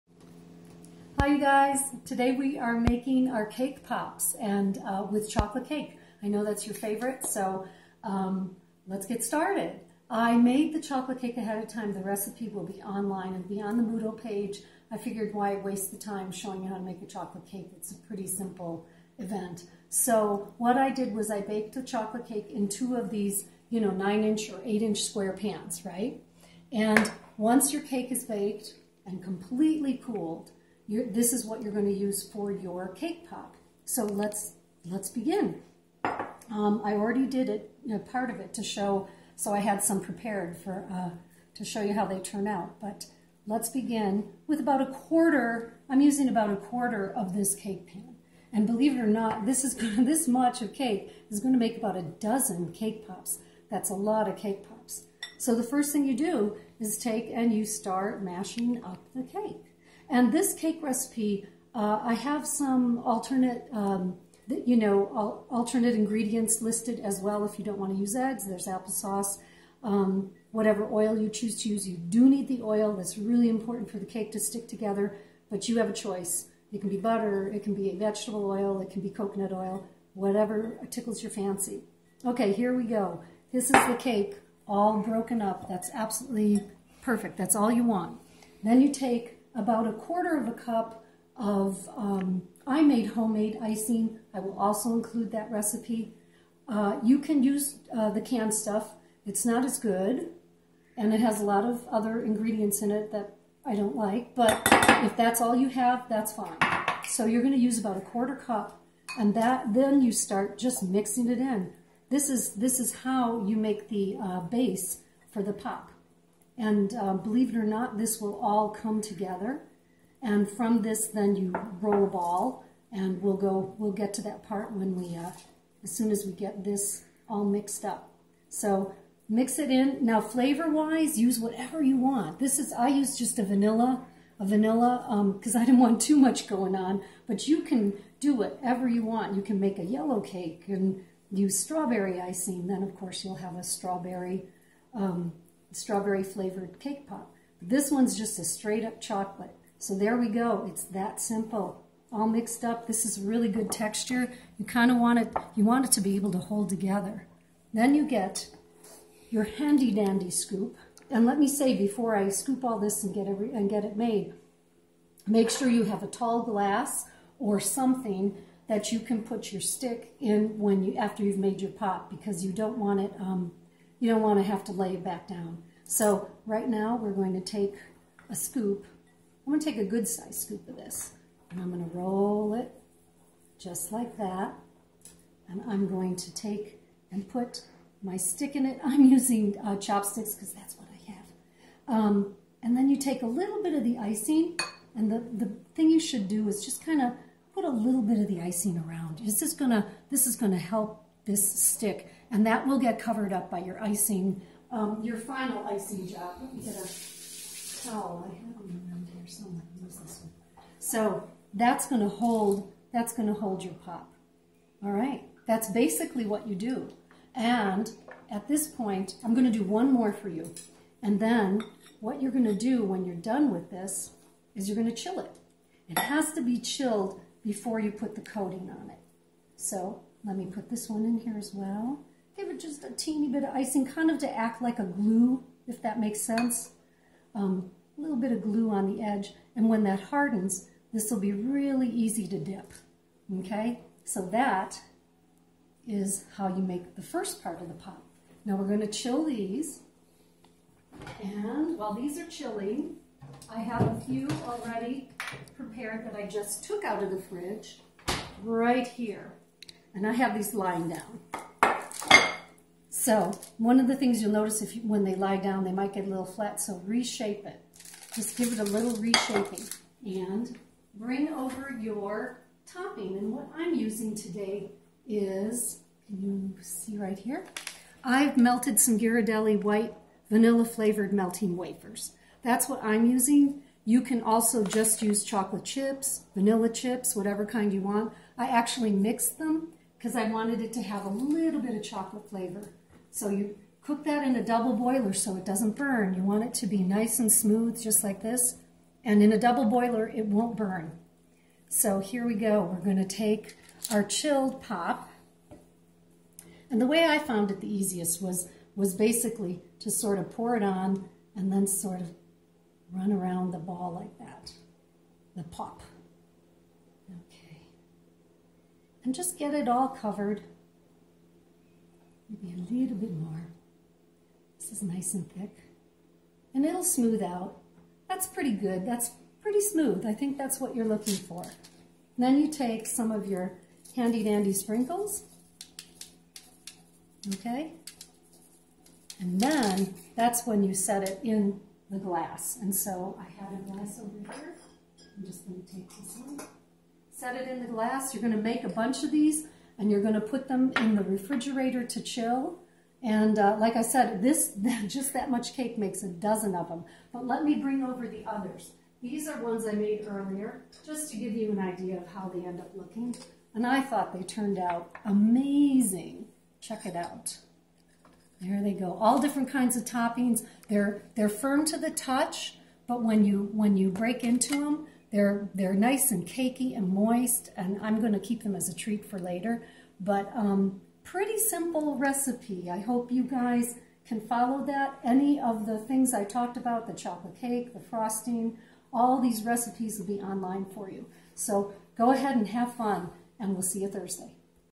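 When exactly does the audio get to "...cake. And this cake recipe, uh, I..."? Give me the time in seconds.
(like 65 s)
59 s.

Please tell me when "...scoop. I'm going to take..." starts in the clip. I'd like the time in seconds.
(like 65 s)
178 s.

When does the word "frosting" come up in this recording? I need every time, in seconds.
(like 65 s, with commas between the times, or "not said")
387 s.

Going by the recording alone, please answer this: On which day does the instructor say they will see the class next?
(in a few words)
Thursday.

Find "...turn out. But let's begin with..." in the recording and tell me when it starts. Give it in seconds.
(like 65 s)
42 s.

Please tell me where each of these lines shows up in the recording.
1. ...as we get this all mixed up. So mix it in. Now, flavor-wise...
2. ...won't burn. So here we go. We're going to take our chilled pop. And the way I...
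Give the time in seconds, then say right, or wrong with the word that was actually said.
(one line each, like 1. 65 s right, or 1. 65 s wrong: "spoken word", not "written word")
1. 126 s right
2. 300 s right.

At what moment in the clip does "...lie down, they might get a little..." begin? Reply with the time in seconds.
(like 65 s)
265 s.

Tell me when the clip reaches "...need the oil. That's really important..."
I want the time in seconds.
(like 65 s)
72 s.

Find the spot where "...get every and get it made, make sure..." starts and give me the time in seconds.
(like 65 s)
163 s.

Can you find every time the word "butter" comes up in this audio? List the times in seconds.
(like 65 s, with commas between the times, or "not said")
76 s.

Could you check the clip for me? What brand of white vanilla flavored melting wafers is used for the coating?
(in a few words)
Ghirardelli.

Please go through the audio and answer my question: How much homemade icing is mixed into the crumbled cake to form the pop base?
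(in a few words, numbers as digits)
a quarter cup.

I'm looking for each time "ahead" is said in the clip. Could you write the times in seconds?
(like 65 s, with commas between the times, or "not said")
11 s, 392 s.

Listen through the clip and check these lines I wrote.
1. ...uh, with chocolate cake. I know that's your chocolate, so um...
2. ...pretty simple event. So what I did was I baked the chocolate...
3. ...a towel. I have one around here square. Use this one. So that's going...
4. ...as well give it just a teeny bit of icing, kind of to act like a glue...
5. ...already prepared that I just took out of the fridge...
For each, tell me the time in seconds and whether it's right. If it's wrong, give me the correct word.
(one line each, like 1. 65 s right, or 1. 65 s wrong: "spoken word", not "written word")
1. 4 s wrong: "favorite", not "chocolate"
2. 18 s right
3. 206 s wrong: "somewhere", not "square"
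4. 231 s right
5. 254 s right.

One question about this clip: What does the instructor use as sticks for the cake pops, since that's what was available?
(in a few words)
chopsticks.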